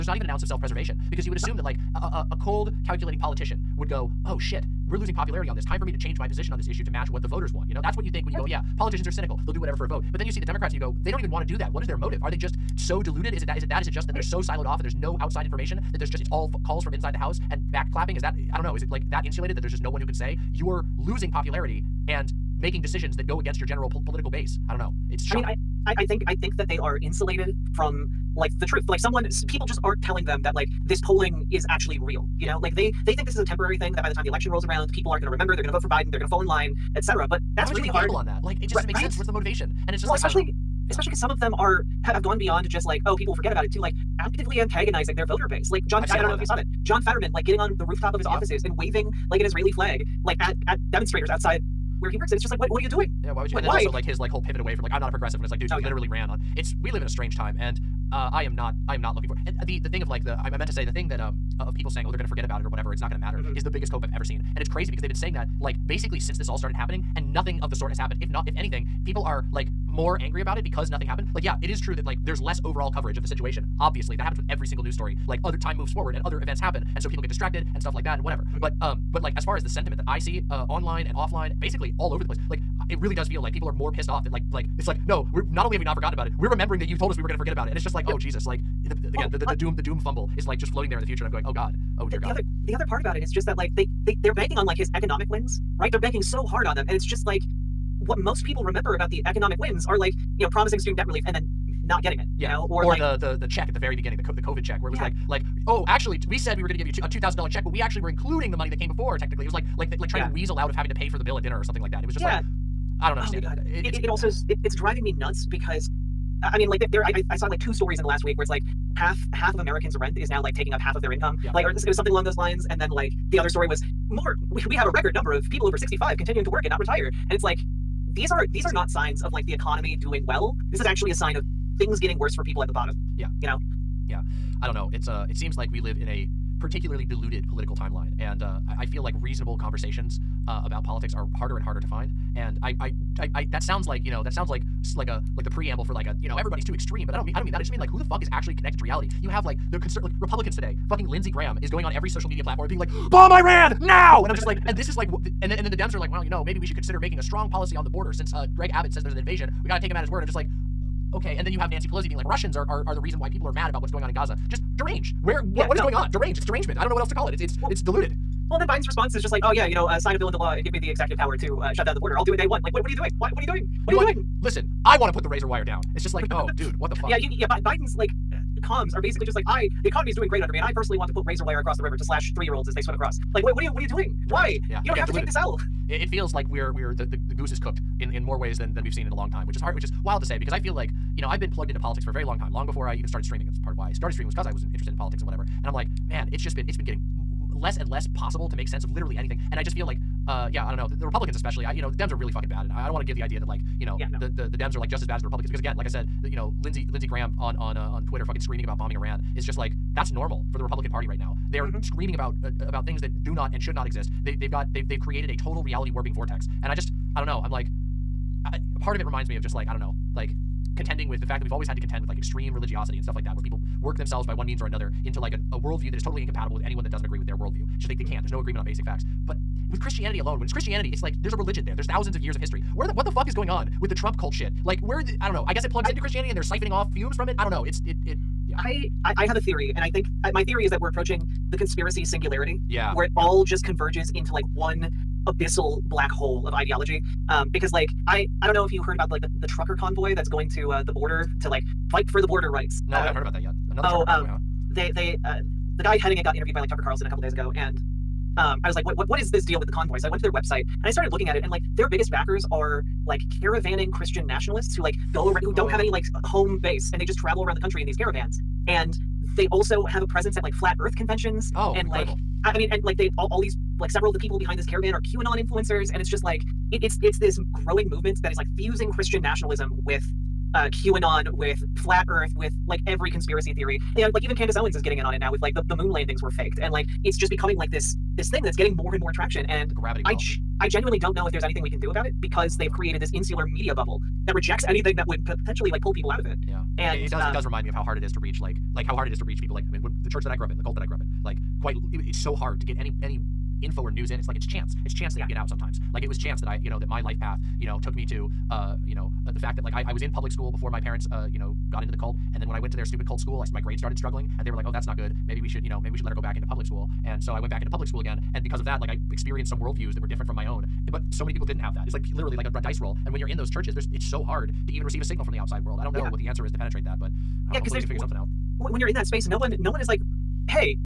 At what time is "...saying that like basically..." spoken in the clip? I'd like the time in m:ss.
1:05.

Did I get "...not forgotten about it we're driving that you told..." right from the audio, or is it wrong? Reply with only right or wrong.
wrong.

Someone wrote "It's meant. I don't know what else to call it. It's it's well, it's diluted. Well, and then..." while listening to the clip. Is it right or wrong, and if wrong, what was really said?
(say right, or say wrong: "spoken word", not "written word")
wrong: "derangement", not "meant".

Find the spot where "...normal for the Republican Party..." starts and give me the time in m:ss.
3:30.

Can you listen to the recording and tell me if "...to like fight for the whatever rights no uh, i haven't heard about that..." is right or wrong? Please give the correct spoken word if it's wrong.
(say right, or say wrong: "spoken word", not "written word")
wrong: "border", not "whatever".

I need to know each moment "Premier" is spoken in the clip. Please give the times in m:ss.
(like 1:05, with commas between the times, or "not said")
not said.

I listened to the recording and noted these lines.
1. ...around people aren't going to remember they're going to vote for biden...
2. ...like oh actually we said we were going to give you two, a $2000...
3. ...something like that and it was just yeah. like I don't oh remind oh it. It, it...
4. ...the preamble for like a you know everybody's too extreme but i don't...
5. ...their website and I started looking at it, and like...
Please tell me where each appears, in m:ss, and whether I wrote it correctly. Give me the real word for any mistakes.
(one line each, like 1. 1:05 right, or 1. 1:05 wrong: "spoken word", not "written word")
1. 0:34 right
2. 1:45 right
3. 1:51 wrong: "understand", not "remind"
4. 2:25 right
5. 4:20 right.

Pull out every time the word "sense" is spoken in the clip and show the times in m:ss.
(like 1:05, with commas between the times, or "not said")
0:39, 3:18.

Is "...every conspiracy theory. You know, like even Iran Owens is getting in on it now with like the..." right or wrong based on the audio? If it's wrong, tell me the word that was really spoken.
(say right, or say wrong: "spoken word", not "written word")
wrong: "Candace", not "Iran".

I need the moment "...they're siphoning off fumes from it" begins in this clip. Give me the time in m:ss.
3:56.